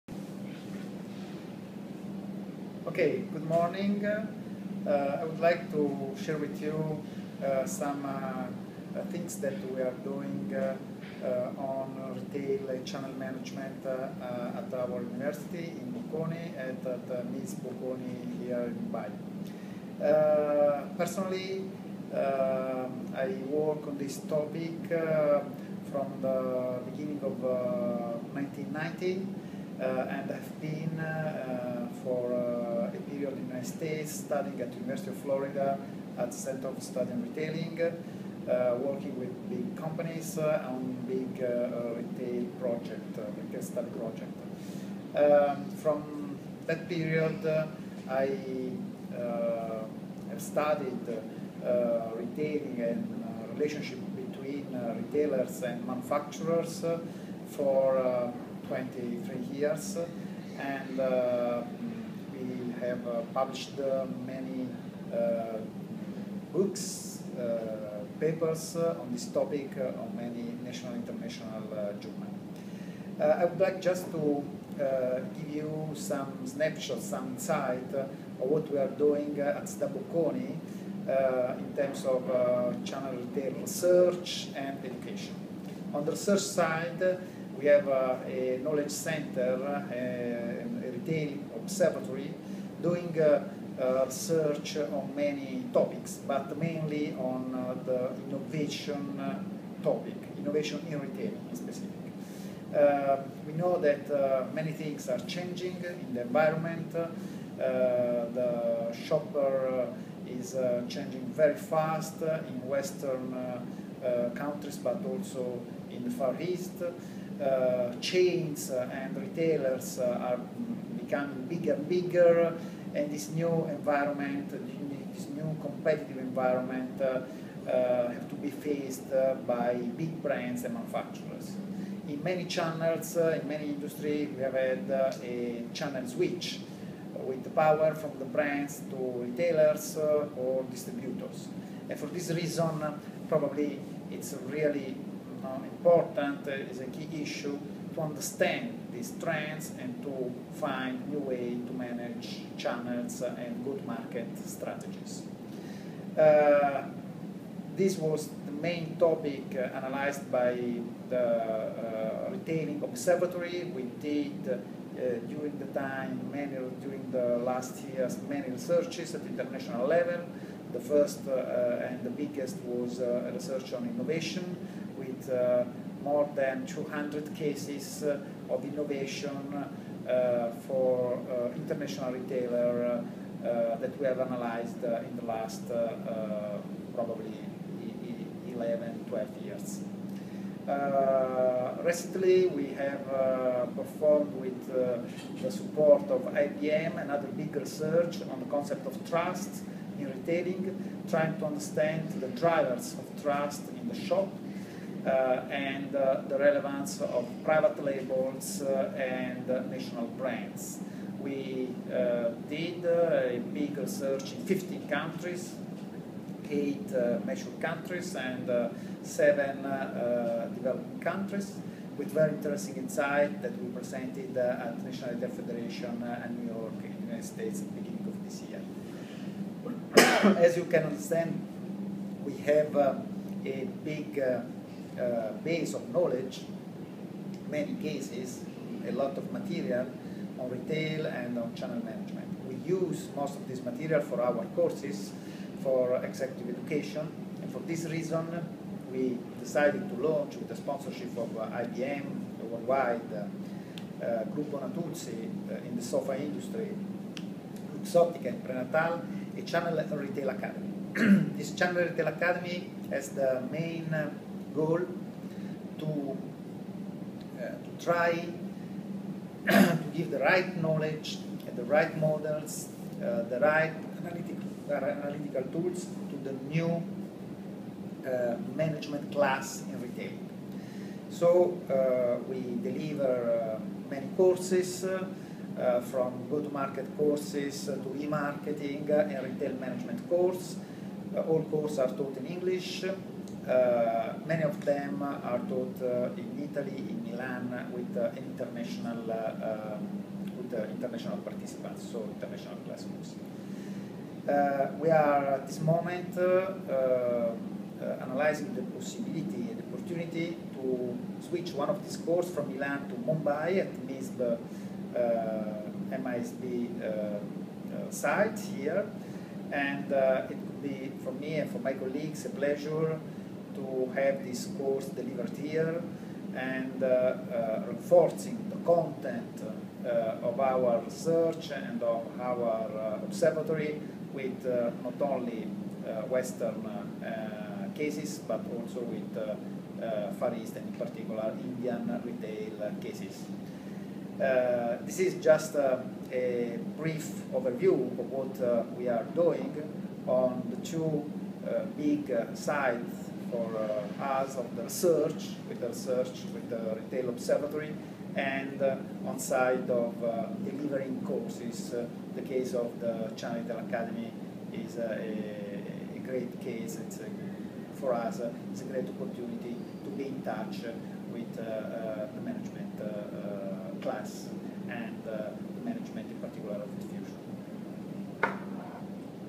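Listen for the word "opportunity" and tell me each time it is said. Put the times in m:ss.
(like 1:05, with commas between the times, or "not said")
5:09, 6:08.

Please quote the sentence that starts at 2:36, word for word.
Uh, this was the main topic uh, analyzed by the uh, Retailing Observatory.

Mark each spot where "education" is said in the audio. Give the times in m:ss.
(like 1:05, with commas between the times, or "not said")
1:24, 4:06.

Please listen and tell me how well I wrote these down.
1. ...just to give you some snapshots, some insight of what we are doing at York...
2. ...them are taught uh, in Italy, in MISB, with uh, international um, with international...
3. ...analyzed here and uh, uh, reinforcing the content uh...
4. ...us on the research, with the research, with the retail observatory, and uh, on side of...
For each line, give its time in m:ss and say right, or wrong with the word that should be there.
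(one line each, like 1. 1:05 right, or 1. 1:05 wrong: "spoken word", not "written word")
1. 1:13 wrong: "SDA", not "York"
2. 4:54 wrong: "Milan", not "MISB"
3. 5:24 wrong: "delivered", not "analyzed"
4. 5:54 right.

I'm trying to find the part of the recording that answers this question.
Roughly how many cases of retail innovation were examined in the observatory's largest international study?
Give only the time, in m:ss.
2:56.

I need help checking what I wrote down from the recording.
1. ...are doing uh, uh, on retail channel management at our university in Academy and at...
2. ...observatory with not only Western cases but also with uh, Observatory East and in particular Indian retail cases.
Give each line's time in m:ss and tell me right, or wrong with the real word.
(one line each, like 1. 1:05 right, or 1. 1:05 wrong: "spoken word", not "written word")
1. 0:09 wrong: "Bocconi", not "Academy"
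2. 5:33 wrong: "Far", not "Observatory".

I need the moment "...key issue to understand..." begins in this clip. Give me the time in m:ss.
2:26.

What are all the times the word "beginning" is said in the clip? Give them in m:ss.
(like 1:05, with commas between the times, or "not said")
0:26, 3:47.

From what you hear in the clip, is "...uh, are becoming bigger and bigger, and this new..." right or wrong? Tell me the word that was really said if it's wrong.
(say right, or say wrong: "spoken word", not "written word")
right.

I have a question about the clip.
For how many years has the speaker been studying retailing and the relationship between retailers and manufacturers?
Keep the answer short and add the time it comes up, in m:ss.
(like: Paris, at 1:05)
23, at 0:58.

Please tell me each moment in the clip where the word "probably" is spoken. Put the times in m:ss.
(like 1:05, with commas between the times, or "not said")
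2:23, 3:06.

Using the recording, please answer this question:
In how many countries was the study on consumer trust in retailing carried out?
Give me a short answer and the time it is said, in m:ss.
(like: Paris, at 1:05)
15, at 3:34.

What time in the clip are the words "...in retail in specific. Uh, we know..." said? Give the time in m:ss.
1:40.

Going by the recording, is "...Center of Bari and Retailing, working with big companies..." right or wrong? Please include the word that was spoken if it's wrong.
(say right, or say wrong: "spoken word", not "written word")
wrong: "Study", not "Bari".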